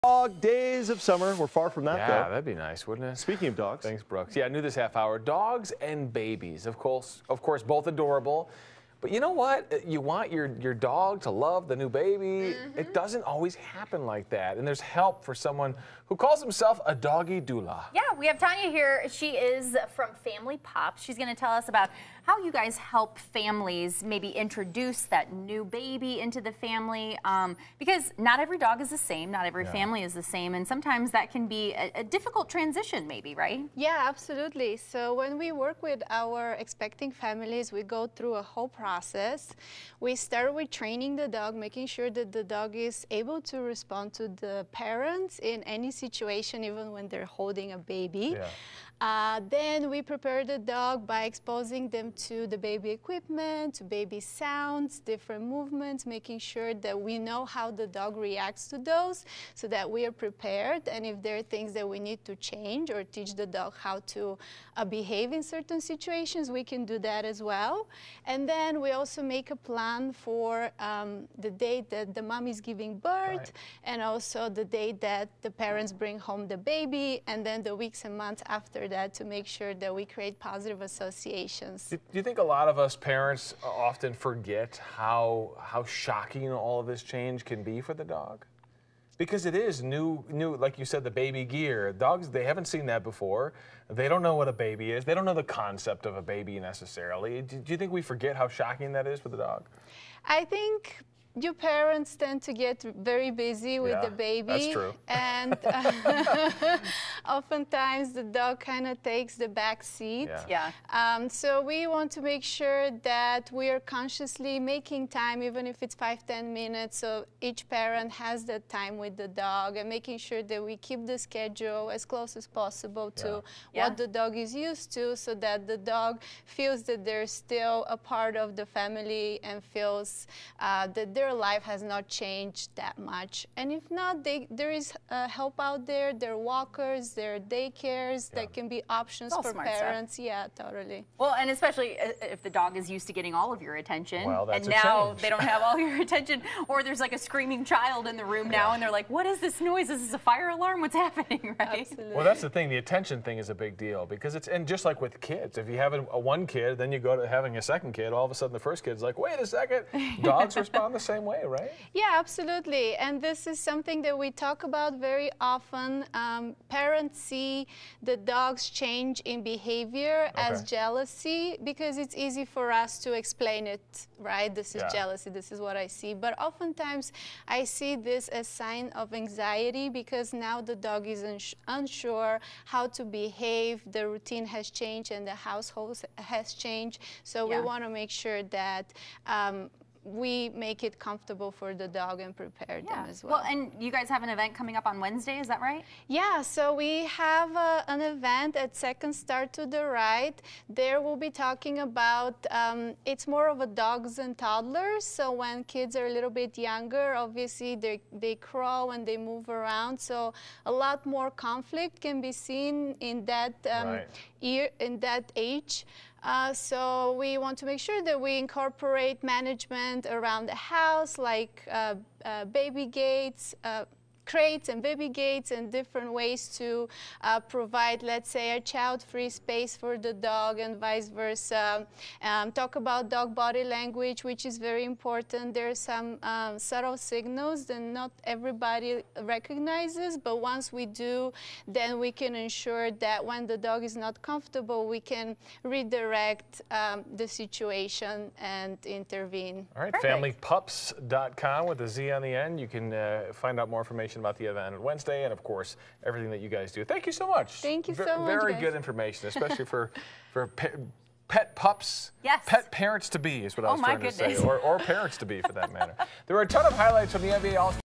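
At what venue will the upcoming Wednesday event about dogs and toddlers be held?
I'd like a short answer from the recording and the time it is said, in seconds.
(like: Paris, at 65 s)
Second Star to the Right, at 198 s.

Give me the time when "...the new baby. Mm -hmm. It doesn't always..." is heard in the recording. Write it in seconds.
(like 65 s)
11 s.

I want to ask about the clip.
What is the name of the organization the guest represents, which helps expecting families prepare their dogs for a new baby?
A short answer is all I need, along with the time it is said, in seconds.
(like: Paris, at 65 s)
Family Pop, at 20 s.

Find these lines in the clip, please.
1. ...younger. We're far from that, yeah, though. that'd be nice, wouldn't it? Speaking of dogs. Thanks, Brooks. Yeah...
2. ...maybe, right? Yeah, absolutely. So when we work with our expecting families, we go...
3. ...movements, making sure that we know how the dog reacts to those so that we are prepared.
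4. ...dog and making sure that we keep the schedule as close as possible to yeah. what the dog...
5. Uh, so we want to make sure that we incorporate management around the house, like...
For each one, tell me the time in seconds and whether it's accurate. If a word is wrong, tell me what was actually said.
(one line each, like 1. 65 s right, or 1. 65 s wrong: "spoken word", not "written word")
1. 0 s wrong: "summer", not "younger"
2. 33 s right
3. 55 s right
4. 119 s right
5. 216 s right.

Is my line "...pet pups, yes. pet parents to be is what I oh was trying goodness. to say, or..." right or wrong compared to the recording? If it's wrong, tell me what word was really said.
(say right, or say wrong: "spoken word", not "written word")
right.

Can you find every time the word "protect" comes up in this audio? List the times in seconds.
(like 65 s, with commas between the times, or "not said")
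not said.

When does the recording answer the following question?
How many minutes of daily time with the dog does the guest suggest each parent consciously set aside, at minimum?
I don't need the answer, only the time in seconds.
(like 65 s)
115 s.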